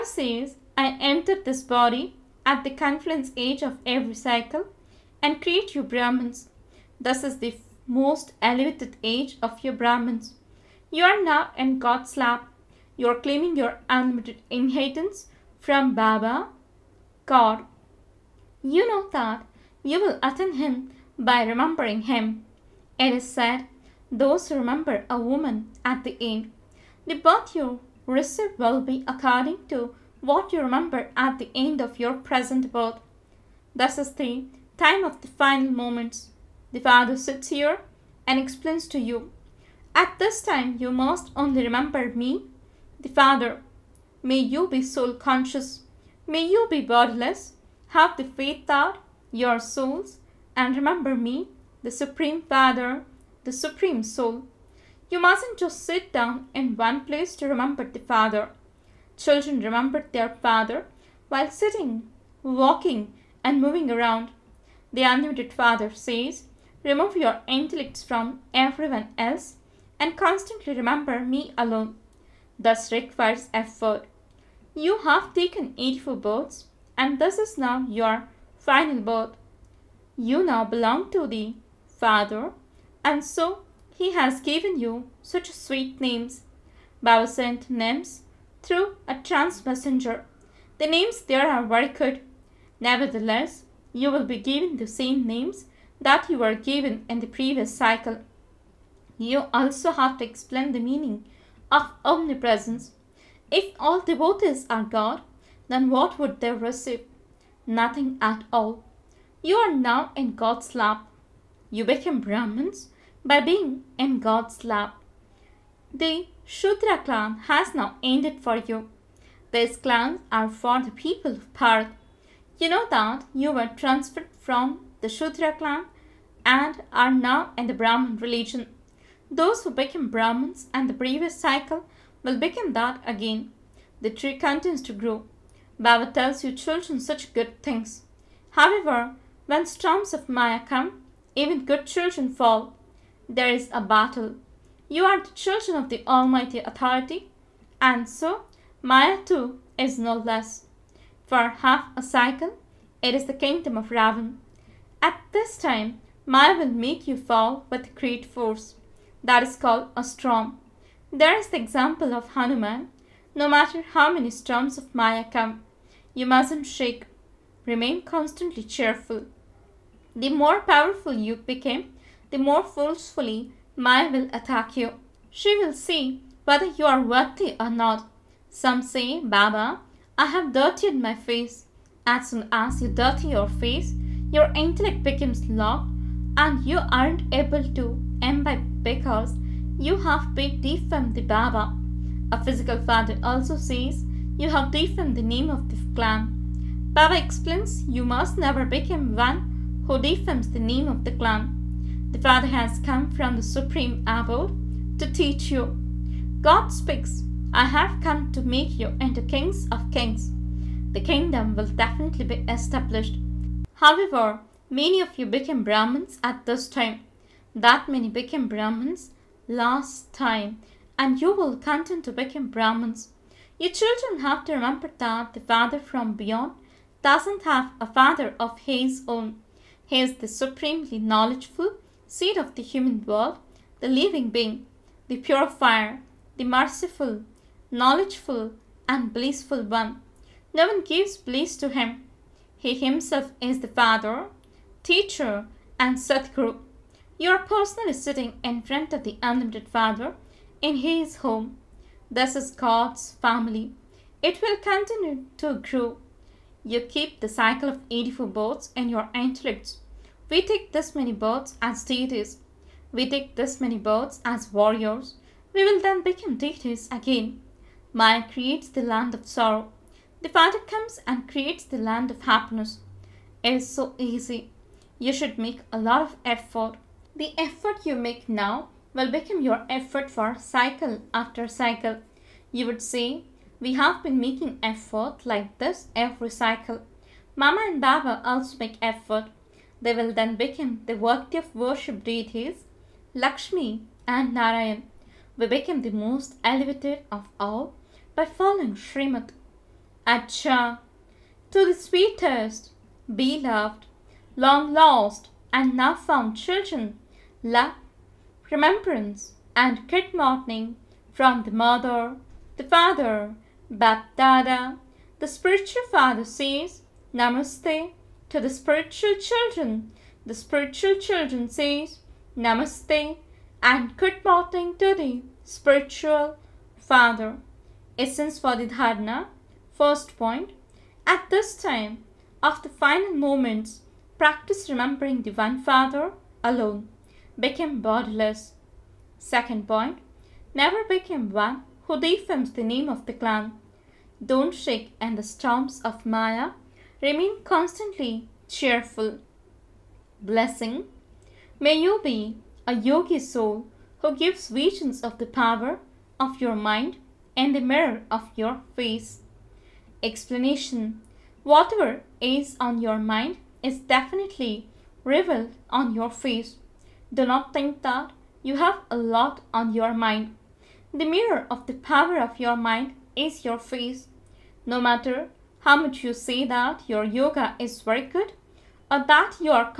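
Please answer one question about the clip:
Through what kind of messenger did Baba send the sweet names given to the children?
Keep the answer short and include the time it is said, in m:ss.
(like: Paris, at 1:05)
trans messenger, at 1:29.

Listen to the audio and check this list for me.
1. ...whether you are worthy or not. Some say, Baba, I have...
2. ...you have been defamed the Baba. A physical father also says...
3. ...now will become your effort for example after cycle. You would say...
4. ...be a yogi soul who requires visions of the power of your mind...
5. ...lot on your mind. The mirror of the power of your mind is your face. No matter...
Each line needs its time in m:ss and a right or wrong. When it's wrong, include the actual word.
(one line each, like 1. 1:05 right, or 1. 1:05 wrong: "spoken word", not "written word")
1. 2:56 right
2. 3:09 right
3. 4:38 wrong: "cycle", not "example"
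4. 5:52 wrong: "gives", not "requires"
5. 6:08 right.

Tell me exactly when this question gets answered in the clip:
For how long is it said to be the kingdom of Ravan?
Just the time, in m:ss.
2:31.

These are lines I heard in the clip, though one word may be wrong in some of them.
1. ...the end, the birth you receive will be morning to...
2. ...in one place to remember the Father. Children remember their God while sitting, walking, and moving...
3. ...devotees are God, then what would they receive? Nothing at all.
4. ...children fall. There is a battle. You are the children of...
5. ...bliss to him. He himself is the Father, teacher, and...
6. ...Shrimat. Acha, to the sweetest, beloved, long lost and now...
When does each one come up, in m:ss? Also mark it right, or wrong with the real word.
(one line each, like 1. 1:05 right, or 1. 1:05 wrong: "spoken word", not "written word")
1. 0:26 wrong: "according", not "morning"
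2. 0:56 wrong: "Father", not "God"
3. 1:44 right
4. 2:21 right
5. 4:01 right
6. 4:58 right.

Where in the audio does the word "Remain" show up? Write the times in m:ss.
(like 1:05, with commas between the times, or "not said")
2:47, 5:47.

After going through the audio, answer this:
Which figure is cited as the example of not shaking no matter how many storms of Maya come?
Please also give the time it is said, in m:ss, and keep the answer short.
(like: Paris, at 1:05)
Hanuman, at 2:42.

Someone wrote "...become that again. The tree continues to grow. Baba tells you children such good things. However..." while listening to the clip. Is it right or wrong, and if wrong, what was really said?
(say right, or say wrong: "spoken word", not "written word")
right.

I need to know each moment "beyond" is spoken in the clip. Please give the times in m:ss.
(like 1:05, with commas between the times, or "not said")
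3:46.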